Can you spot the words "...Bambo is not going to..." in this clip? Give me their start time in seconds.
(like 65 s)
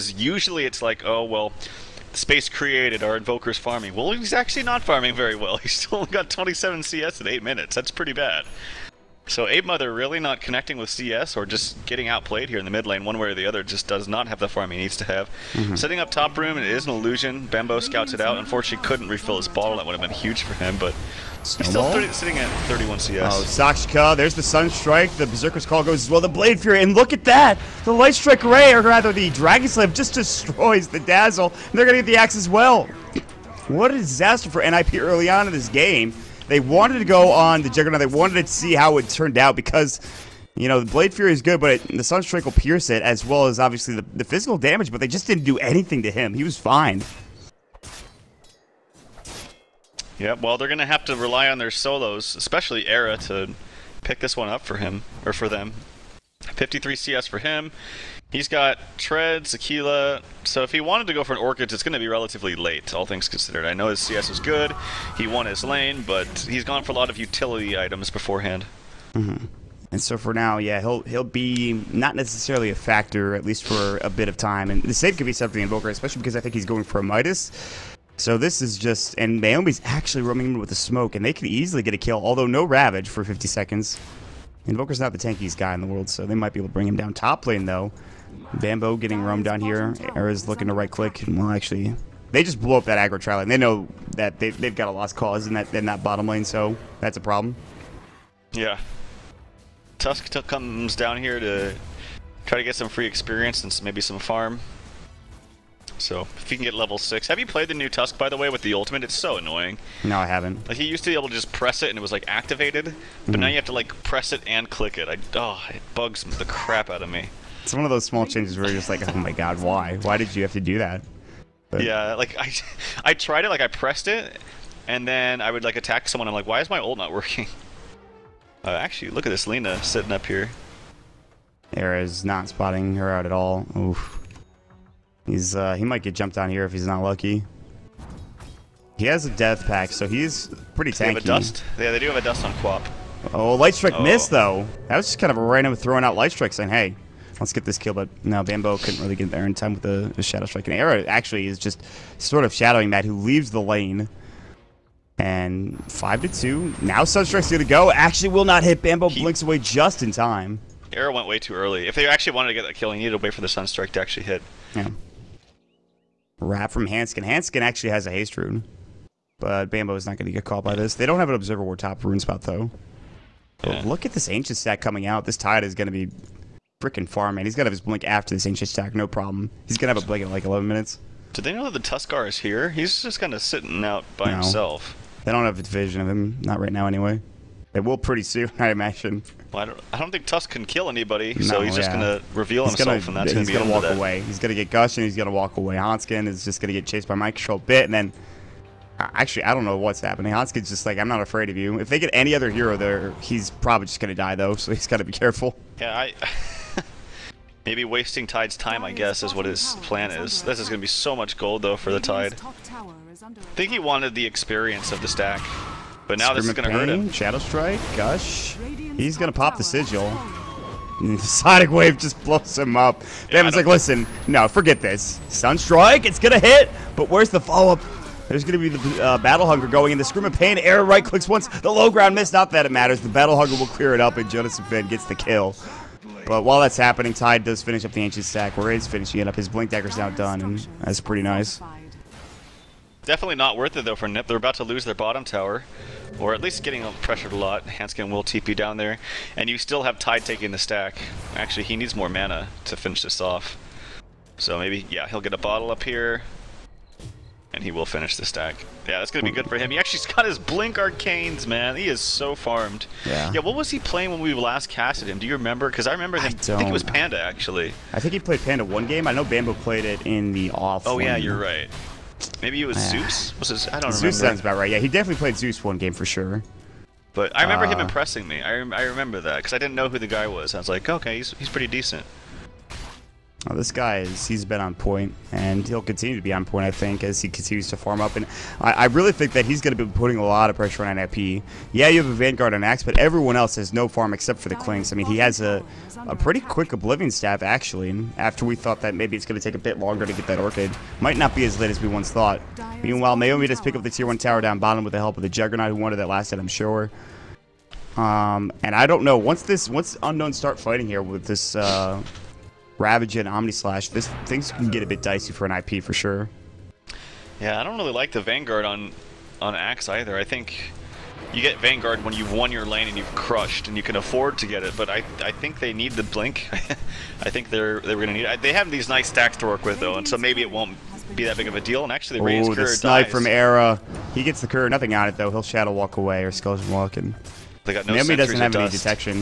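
169 s.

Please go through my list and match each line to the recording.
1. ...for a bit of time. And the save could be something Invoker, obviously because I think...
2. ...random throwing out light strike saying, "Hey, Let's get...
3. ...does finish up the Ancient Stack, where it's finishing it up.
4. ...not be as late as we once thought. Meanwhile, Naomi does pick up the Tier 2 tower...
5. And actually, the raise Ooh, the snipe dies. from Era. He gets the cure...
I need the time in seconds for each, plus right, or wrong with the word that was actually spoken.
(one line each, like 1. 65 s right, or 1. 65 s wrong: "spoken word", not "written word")
1. 73 s wrong: "especially", not "obviously"
2. 145 s right
3. 237 s right
4. 301 s wrong: "1", not "2"
5. 331 s right.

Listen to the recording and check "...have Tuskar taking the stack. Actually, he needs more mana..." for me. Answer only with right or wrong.
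wrong.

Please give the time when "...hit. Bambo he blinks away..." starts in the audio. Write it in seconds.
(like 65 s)
158 s.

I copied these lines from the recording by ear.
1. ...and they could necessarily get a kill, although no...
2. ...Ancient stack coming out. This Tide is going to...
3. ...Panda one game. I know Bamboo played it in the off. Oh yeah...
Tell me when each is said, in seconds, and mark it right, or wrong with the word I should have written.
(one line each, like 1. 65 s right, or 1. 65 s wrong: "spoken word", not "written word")
1. 81 s wrong: "easily", not "necessarily"
2. 174 s right
3. 268 s right.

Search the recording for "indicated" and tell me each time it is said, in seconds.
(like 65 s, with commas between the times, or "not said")
not said.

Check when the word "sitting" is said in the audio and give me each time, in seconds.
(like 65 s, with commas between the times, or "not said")
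22 s, 129 s, 183 s.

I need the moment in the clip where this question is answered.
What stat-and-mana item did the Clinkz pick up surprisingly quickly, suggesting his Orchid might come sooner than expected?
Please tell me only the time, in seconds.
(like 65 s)
296 s.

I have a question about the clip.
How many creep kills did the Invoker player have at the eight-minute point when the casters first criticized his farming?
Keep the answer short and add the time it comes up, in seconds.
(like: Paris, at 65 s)
27, at 6 s.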